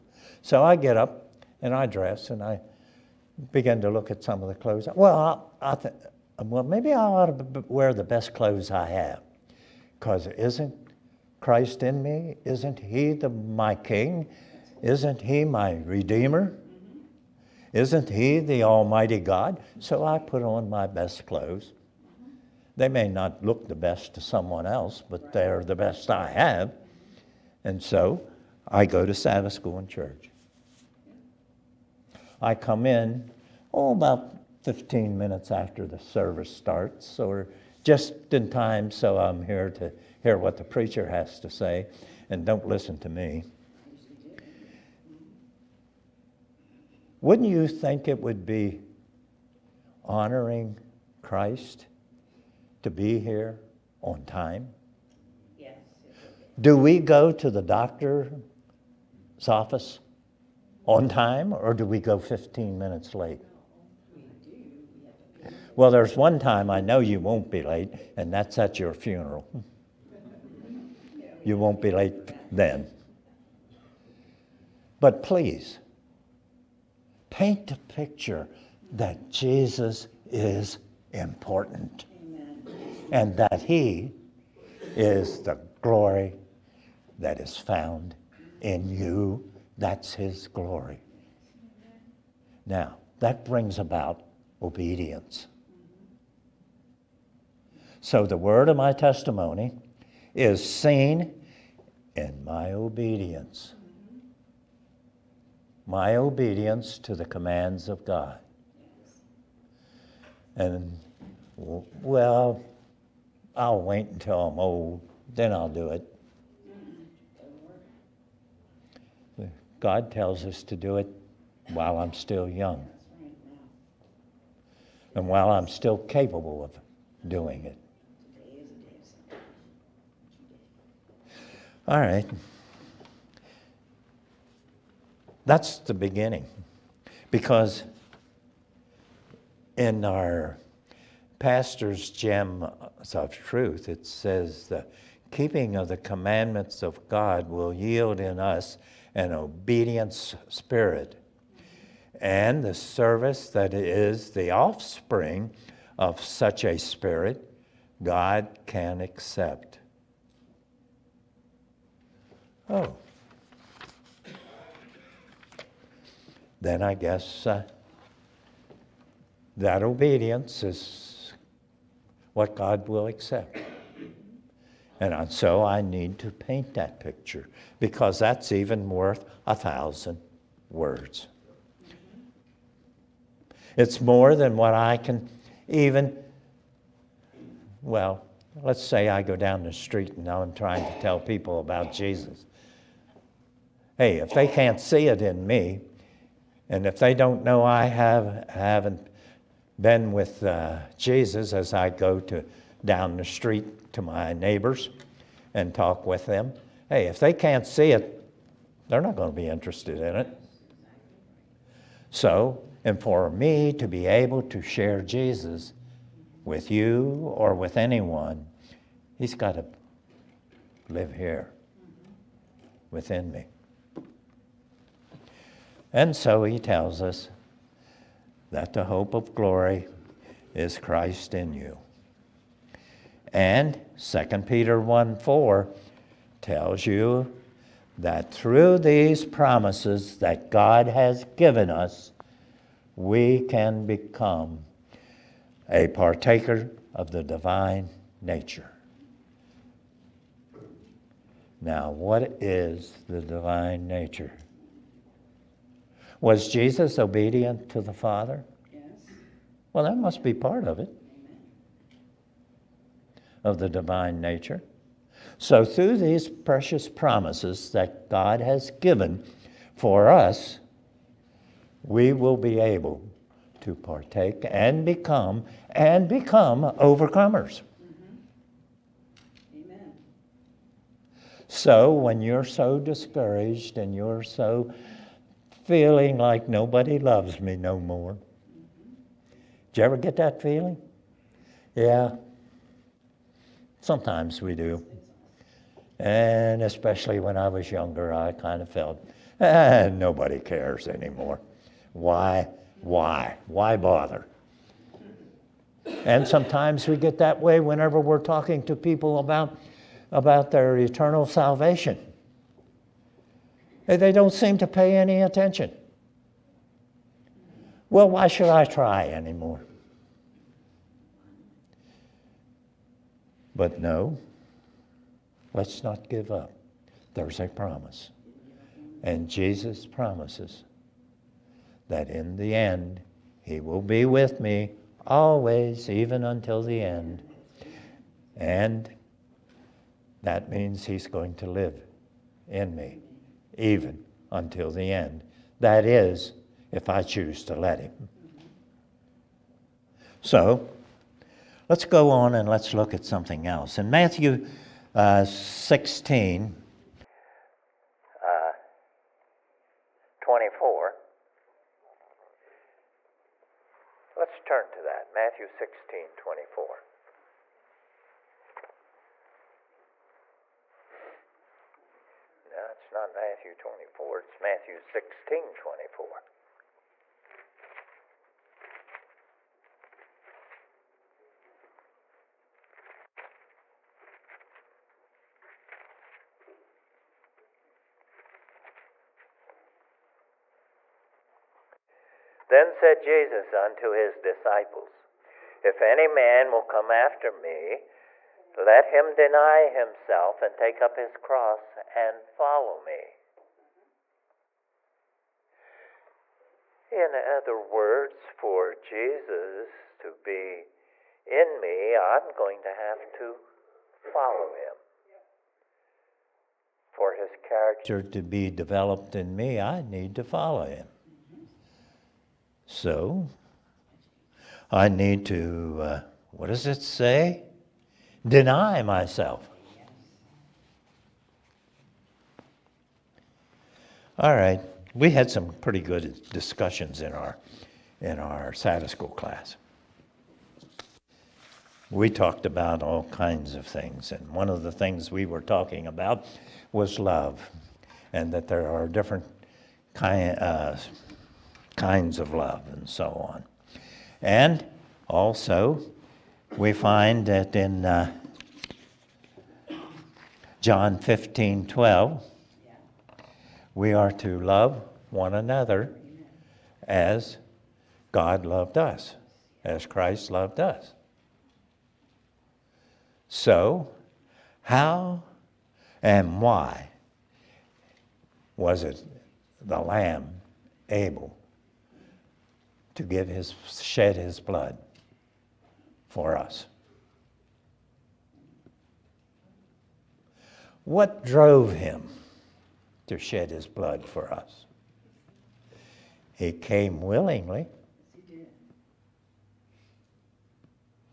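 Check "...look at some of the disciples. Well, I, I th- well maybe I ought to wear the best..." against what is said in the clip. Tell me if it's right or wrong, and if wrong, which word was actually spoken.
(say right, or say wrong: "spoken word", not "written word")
wrong: "clothes", not "disciples".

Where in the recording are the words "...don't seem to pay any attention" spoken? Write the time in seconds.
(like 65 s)
314 s.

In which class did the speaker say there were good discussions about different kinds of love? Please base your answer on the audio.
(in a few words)
Sabbath school class.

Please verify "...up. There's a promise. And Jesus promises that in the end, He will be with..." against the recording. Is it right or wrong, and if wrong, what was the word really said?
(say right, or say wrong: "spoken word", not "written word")
right.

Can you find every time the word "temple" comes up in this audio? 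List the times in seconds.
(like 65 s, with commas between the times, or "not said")
not said.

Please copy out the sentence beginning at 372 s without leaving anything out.
No, it's not Matthew 24, it's Matthew 16 24.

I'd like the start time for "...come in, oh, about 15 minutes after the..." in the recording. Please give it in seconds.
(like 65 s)
32 s.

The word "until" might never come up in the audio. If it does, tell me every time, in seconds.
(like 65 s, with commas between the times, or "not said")
114 s, 336 s, 344 s.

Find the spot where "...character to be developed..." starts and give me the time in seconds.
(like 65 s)
417 s.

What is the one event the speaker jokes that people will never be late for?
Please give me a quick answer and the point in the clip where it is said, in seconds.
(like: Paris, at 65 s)
your funeral, at 68 s.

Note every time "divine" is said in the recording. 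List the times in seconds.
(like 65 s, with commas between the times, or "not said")
247 s, 253 s, 263 s.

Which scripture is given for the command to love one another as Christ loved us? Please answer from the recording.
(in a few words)
John 15:12.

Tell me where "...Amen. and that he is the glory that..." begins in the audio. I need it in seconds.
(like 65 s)
82 s.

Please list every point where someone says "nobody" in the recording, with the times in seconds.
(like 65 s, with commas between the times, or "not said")
286 s, 299 s.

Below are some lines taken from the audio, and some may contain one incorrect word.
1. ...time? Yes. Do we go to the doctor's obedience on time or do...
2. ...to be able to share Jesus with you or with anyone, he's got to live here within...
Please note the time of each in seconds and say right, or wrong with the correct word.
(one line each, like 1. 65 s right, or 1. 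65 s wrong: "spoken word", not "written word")
1. 54 s wrong: "office", not "obedience"
2. 213 s right.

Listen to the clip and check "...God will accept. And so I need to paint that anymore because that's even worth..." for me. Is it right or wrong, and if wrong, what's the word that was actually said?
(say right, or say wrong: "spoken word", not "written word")
wrong: "picture", not "anymore".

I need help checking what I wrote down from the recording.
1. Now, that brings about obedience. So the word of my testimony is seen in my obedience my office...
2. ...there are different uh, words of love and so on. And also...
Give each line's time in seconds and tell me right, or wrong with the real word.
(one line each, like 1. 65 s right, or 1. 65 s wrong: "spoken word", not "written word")
1. 92 s wrong: "obedience", not "office"
2. 448 s wrong: "kinds", not "words".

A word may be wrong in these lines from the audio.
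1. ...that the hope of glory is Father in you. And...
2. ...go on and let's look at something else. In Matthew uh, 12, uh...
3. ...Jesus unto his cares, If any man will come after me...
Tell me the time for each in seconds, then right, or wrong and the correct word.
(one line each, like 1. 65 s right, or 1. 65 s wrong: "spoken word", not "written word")
1. 228 s wrong: "Christ", not "Father"
2. 351 s wrong: "16", not "12"
3. 392 s wrong: "disciples", not "cares".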